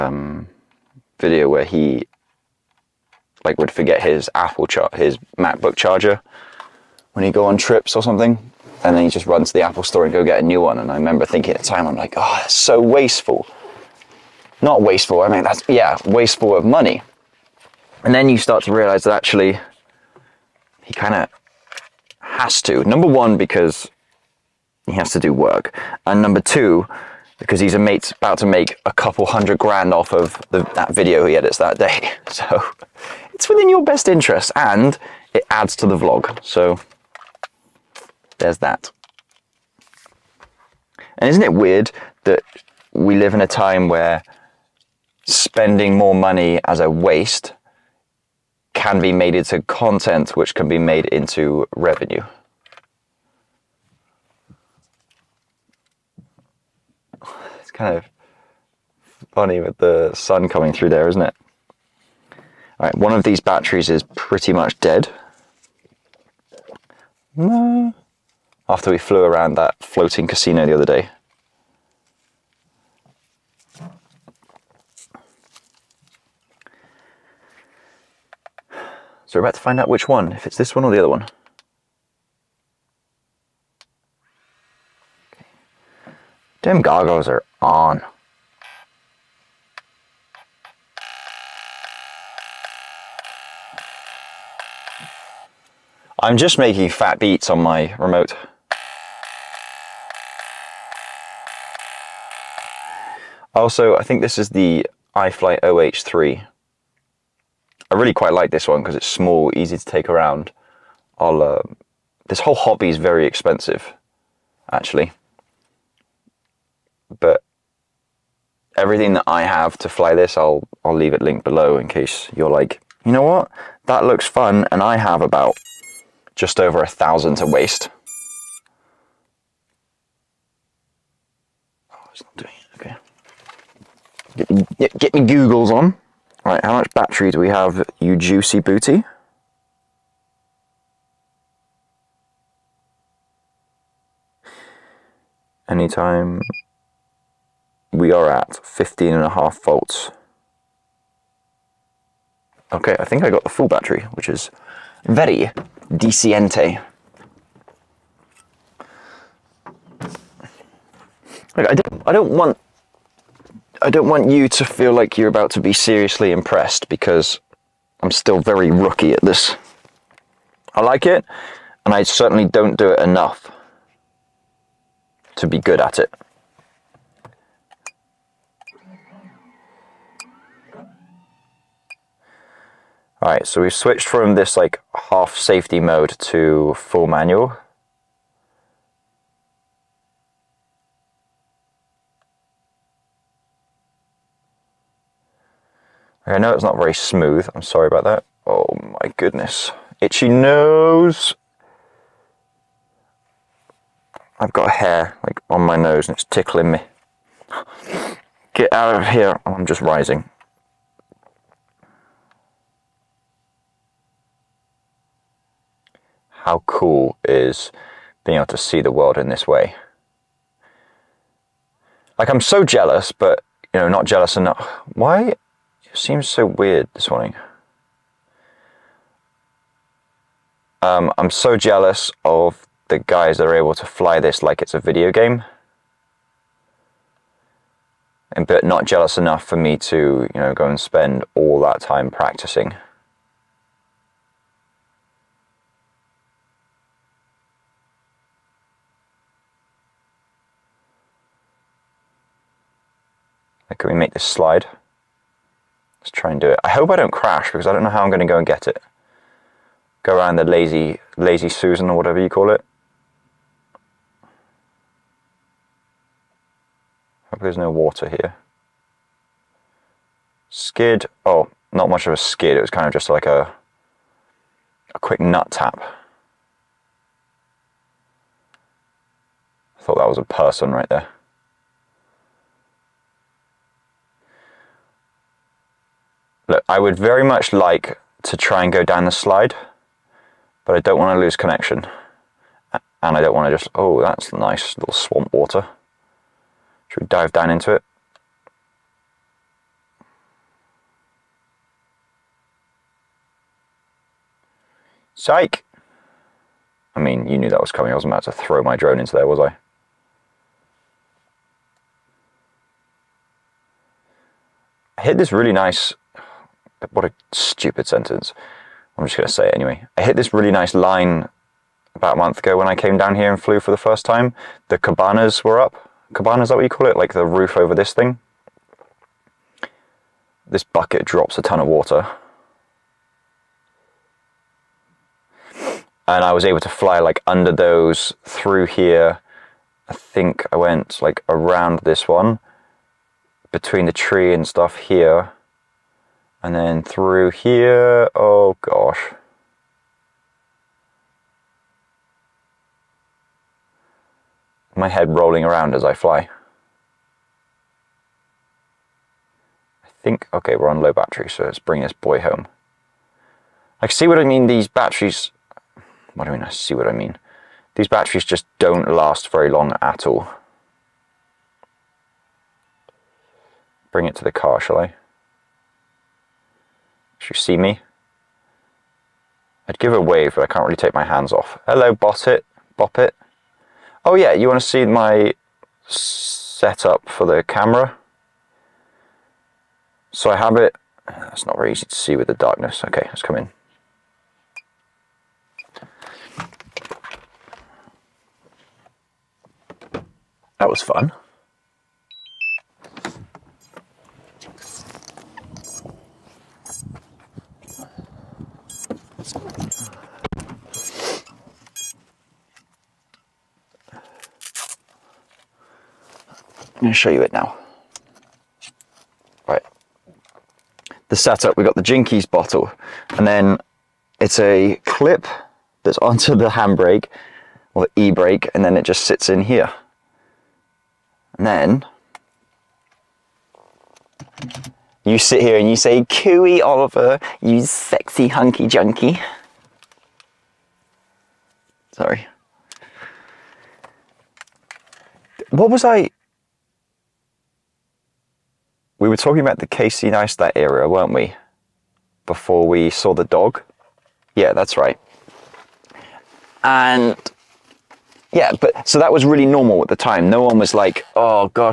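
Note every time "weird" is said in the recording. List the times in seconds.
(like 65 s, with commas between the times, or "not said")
41 s, 226 s.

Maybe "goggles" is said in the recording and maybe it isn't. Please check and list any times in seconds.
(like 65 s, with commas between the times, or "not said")
86 s.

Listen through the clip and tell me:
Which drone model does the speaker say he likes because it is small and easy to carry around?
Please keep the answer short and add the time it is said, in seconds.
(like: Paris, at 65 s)
iFlight iH3, at 105 s.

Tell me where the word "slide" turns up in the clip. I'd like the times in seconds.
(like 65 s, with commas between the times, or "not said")
254 s, 289 s.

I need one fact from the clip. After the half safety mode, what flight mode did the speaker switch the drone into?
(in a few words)
full manual.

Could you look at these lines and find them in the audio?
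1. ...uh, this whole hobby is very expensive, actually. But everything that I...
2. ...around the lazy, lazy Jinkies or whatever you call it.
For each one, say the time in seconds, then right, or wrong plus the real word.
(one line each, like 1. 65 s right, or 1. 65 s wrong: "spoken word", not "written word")
1. 111 s right
2. 260 s wrong: "Susan", not "Jinkies".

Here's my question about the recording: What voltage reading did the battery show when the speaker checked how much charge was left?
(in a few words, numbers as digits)
15.5 volts.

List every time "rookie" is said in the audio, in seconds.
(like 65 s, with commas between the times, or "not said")
168 s.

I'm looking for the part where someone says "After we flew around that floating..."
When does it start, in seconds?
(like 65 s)
68 s.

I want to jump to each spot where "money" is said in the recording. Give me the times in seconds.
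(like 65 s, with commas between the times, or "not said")
16 s, 46 s.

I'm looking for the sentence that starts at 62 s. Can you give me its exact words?
All right, one of these batteries is pretty much dead.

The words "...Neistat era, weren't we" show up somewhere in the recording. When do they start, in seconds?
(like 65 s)
450 s.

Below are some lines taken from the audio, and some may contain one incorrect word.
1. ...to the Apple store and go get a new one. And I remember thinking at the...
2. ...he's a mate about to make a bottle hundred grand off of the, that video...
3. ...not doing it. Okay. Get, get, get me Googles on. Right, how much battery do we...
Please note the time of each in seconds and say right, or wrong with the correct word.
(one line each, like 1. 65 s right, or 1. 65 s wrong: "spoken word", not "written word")
1. 9 s right
2. 27 s wrong: "couple", not "bottle"
3. 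132 s right.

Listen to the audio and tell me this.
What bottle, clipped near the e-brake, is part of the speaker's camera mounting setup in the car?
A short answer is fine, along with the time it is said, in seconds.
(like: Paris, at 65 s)
Jinkies bottle, at 421 s.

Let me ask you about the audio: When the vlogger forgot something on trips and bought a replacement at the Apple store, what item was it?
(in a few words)
MacBook charger.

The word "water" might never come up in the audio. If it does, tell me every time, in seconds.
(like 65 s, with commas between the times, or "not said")
267 s, 295 s, 331 s.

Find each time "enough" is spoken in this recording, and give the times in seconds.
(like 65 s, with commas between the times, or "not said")
172 s, 224 s, 239 s.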